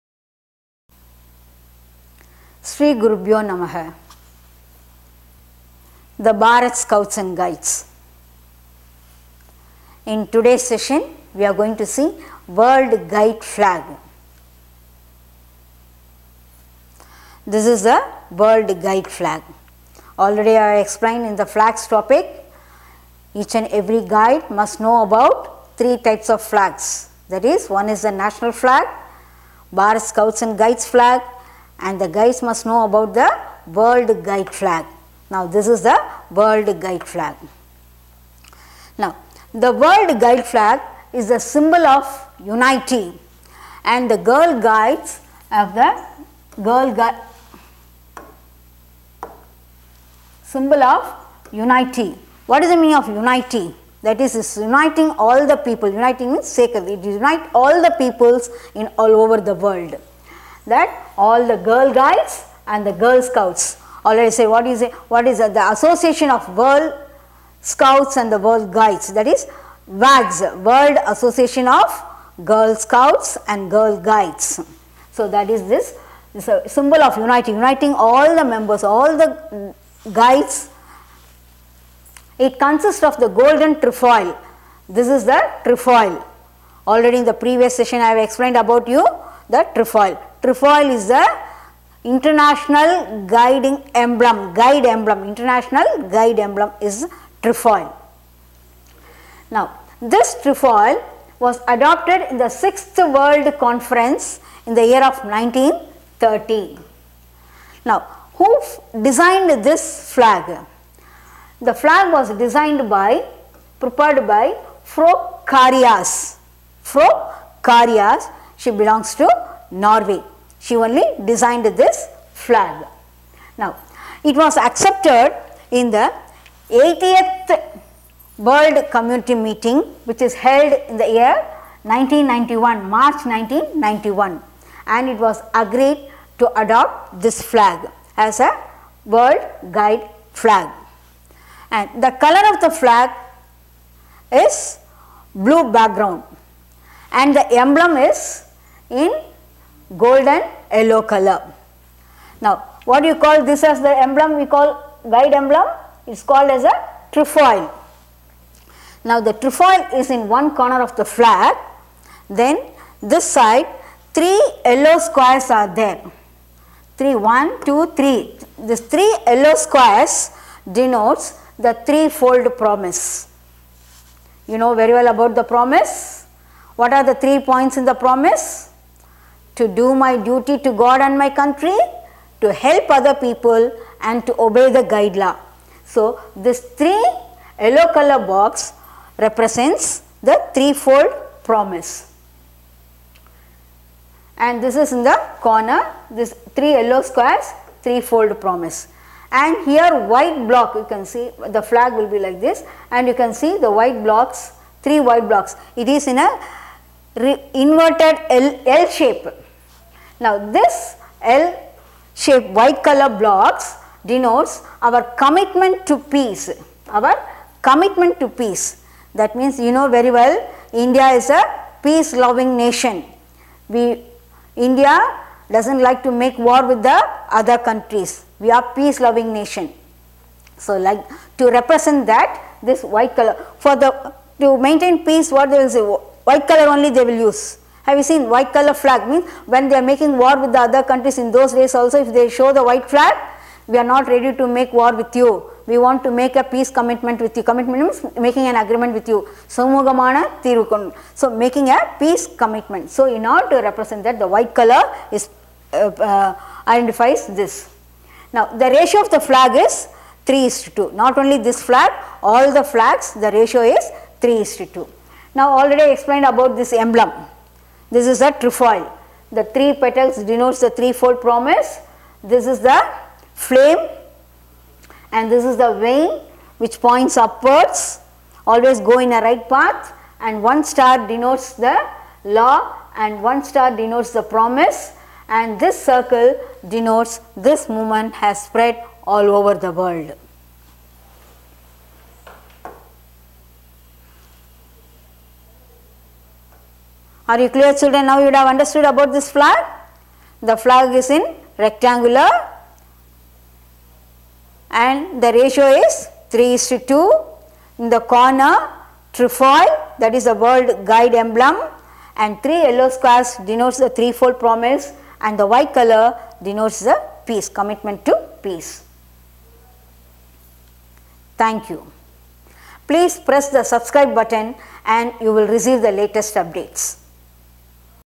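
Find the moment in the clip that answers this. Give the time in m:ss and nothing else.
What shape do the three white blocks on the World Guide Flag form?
3:27.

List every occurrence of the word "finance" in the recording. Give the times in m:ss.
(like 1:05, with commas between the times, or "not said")
not said.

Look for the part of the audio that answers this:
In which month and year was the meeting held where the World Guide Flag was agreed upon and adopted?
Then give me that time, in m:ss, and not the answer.
2:12.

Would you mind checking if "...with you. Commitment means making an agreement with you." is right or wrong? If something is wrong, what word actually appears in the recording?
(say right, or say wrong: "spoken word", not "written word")
right.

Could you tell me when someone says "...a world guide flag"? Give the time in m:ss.
2:18.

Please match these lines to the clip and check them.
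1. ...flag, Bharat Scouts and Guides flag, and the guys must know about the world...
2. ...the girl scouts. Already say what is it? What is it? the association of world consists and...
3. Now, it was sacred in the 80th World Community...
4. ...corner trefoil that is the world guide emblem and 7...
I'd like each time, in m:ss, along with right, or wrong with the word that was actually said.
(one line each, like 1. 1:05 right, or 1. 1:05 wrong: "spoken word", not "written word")
1. 0:28 right
2. 1:02 wrong: "scouts", not "consists"
3. 2:03 wrong: "accepted", not "sacred"
4. 5:08 wrong: "3", not "7".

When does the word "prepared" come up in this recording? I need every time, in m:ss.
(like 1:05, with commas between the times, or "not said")
1:53.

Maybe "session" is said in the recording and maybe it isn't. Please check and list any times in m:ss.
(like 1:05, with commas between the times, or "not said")
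0:10, 1:27.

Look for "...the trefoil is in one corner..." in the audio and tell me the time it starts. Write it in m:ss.
2:39.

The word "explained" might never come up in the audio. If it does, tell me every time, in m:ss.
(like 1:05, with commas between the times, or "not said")
0:20, 1:28, 4:25.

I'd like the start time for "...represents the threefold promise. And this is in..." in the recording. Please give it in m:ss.
3:09.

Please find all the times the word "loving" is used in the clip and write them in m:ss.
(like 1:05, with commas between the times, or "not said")
3:42, 3:48.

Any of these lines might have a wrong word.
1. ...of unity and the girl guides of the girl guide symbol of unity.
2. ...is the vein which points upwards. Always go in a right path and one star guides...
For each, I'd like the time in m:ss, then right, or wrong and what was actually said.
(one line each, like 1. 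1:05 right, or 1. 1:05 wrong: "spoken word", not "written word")
1. 0:41 right
2. 4:35 wrong: "denotes", not "guides".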